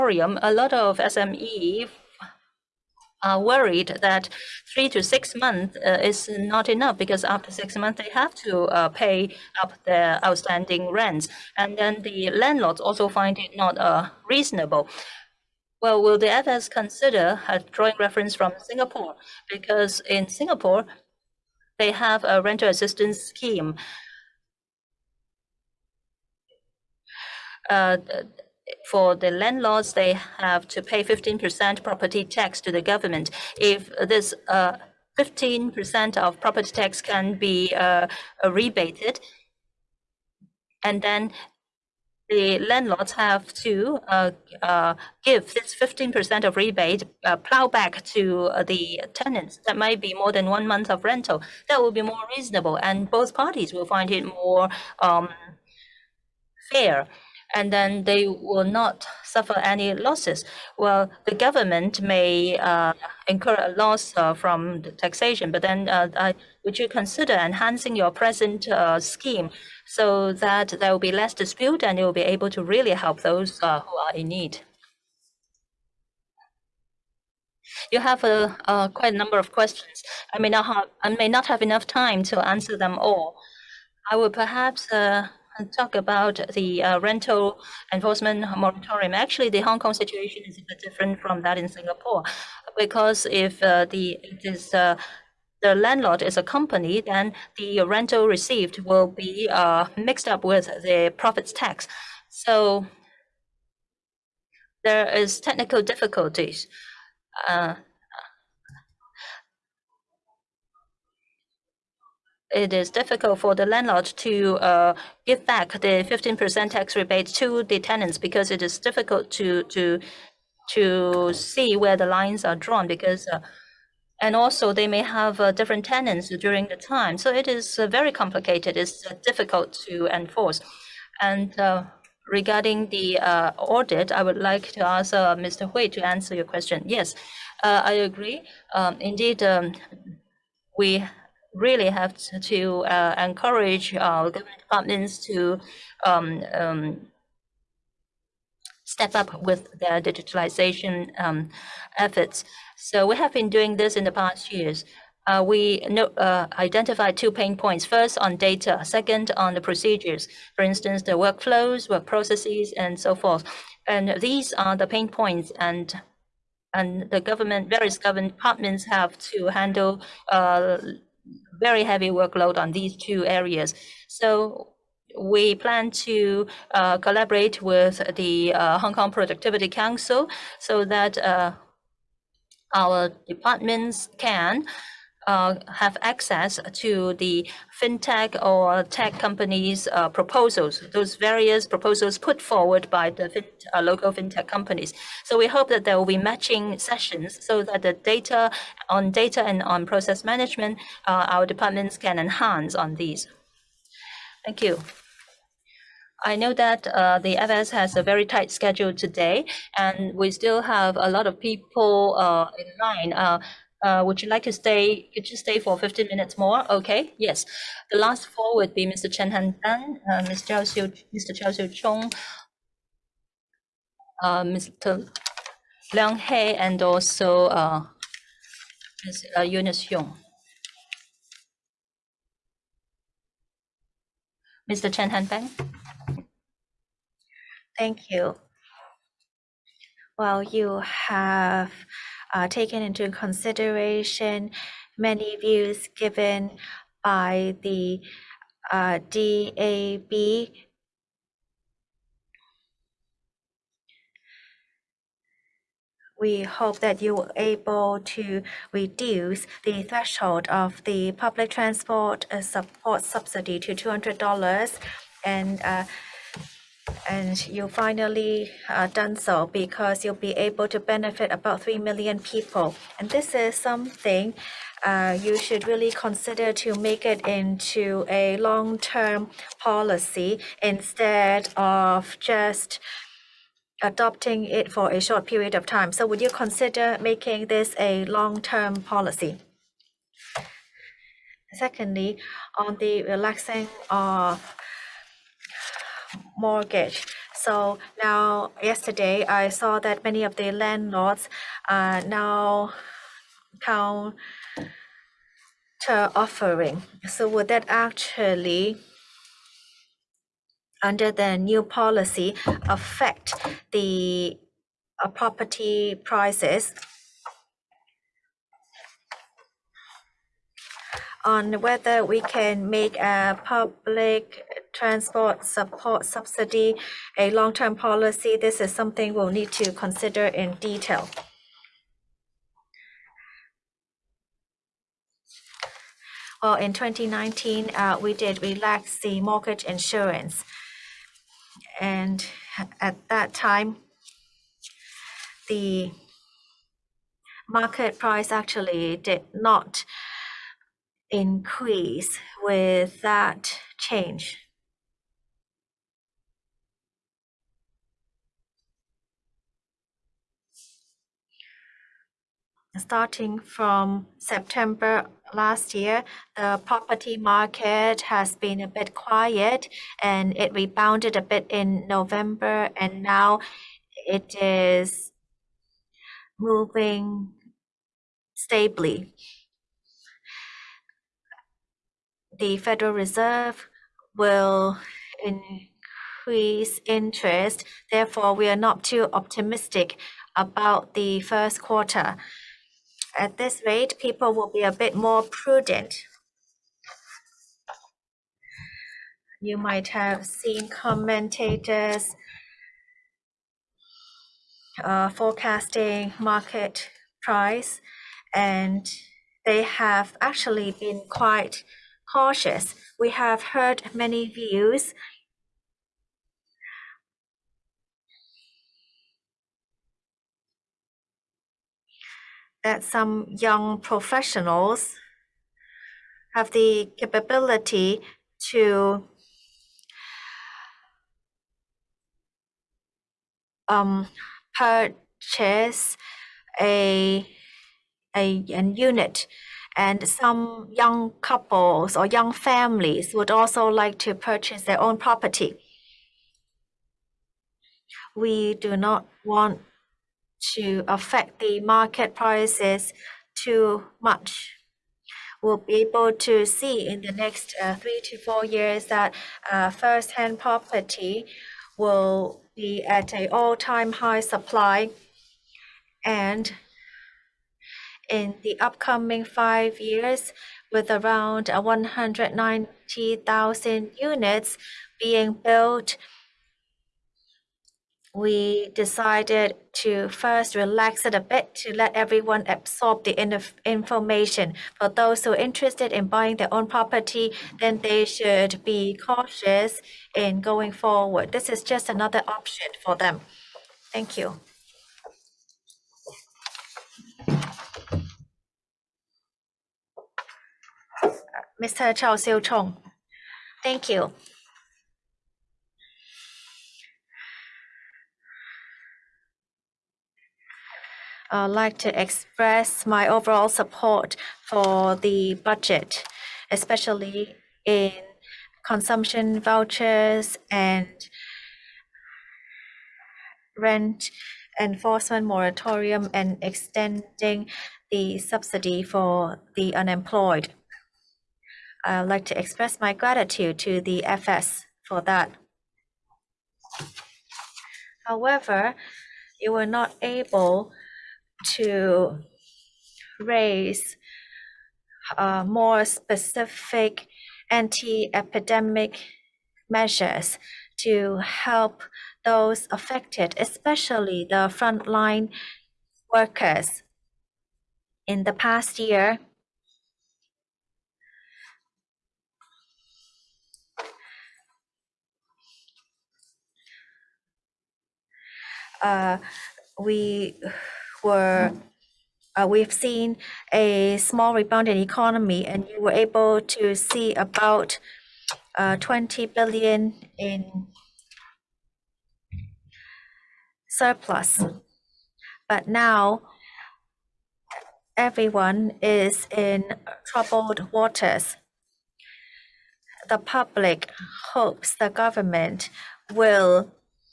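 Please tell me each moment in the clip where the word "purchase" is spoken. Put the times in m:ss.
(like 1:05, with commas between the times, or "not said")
7:14, 7:24.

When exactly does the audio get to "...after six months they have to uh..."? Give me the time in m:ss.
0:07.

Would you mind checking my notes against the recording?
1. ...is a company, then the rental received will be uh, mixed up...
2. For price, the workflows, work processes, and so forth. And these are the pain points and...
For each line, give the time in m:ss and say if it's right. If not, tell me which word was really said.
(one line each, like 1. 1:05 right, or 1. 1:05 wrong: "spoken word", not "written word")
1. 1:36 right
2. 2:40 wrong: "instance", not "price".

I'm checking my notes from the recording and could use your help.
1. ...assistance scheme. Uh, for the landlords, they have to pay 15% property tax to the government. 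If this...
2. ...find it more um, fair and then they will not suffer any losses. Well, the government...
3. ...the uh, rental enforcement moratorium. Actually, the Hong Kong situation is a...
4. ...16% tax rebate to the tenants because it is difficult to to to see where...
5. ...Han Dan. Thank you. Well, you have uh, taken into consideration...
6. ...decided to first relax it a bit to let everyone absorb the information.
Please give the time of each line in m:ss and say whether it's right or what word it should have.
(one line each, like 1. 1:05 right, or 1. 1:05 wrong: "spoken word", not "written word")
1. 0:22 right
2. 0:53 right
3. 1:26 right
4. 1:56 wrong: "15", not "16"
5. 3:55 right
6. 7:58 right.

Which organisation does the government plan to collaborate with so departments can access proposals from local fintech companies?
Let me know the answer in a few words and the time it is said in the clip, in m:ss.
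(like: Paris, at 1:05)
Hong Kong Productivity Council, at 2:58.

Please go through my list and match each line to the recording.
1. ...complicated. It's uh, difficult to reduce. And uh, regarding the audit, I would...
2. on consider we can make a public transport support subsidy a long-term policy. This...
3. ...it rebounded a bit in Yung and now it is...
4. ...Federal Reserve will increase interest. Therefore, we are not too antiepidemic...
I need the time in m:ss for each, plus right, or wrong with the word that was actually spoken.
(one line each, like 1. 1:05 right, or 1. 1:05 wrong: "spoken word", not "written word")
1. 2:08 wrong: "enforce", not "reduce"
2. 5:21 wrong: "whether", not "consider"
3. 6:10 wrong: "November", not "Yung"
4. 6:22 wrong: "optimistic", not "antiepidemic".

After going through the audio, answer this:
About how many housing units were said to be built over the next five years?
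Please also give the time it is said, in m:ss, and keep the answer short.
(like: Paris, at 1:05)
190,000, at 7:51.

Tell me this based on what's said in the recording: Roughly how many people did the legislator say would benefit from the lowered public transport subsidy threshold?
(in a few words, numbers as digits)
3 million.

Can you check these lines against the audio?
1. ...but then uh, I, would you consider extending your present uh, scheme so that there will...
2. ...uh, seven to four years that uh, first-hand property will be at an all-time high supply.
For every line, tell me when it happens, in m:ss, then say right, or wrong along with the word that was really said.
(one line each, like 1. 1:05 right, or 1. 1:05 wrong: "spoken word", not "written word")
1. 1:05 wrong: "enhancing", not "extending"
2. 7:37 wrong: "three", not "seven".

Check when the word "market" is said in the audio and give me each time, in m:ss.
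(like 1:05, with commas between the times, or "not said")
5:47, 6:07, 6:46, 7:31.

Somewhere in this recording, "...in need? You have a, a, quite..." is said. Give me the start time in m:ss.
1:14.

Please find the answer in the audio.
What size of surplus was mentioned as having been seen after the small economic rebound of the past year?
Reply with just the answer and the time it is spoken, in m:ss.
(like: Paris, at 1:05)
20 billion, at 9:38.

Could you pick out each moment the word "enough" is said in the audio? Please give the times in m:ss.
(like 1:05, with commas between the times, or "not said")
0:06, 1:21.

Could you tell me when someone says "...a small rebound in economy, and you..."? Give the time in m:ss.
9:33.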